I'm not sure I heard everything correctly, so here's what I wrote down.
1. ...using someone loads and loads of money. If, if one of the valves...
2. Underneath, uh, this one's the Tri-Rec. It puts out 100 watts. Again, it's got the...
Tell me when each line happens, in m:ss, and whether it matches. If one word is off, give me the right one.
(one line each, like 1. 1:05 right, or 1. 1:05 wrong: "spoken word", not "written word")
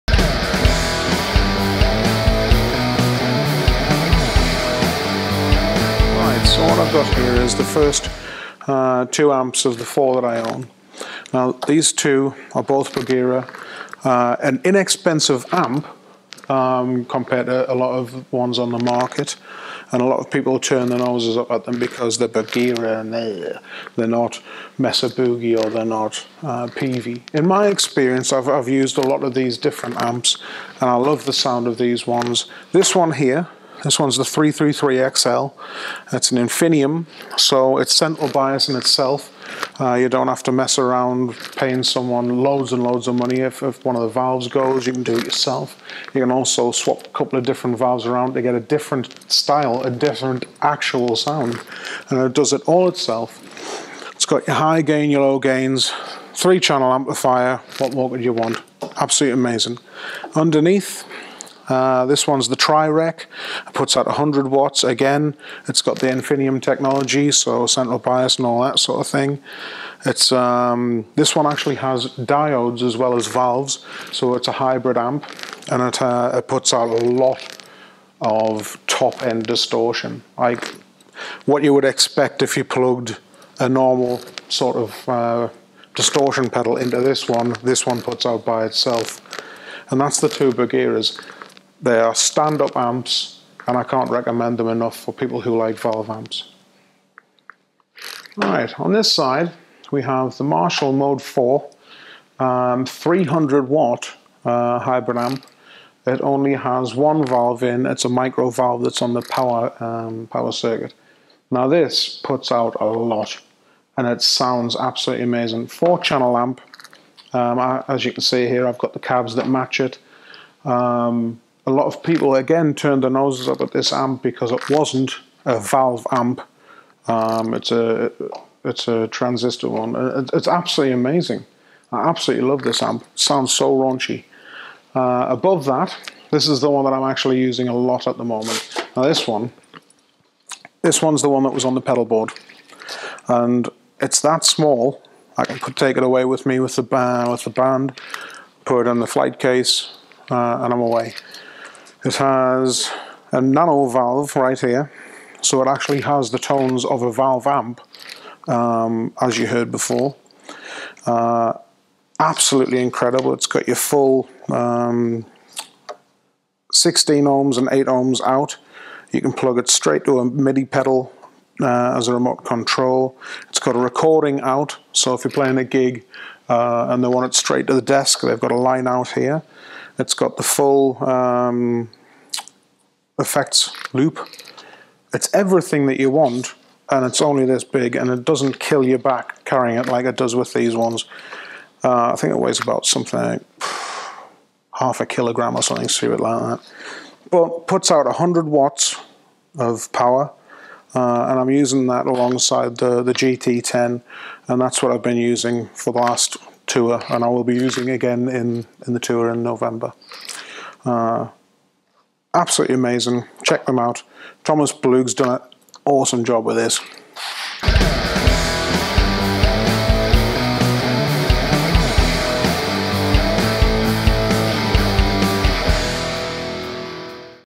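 1. 0:41 wrong: "paying", not "using"
2. 1:00 right.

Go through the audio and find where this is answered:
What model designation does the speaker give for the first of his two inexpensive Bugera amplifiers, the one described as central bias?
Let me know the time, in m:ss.
0:34.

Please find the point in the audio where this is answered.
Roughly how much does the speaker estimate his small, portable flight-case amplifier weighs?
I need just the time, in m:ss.
3:14.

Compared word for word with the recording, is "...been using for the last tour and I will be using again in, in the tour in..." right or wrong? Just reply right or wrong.
right.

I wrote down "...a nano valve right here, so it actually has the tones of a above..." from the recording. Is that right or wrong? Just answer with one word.
wrong.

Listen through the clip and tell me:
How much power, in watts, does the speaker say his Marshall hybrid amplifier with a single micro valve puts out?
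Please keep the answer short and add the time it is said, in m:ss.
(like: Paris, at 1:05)
300 watts, at 1:42.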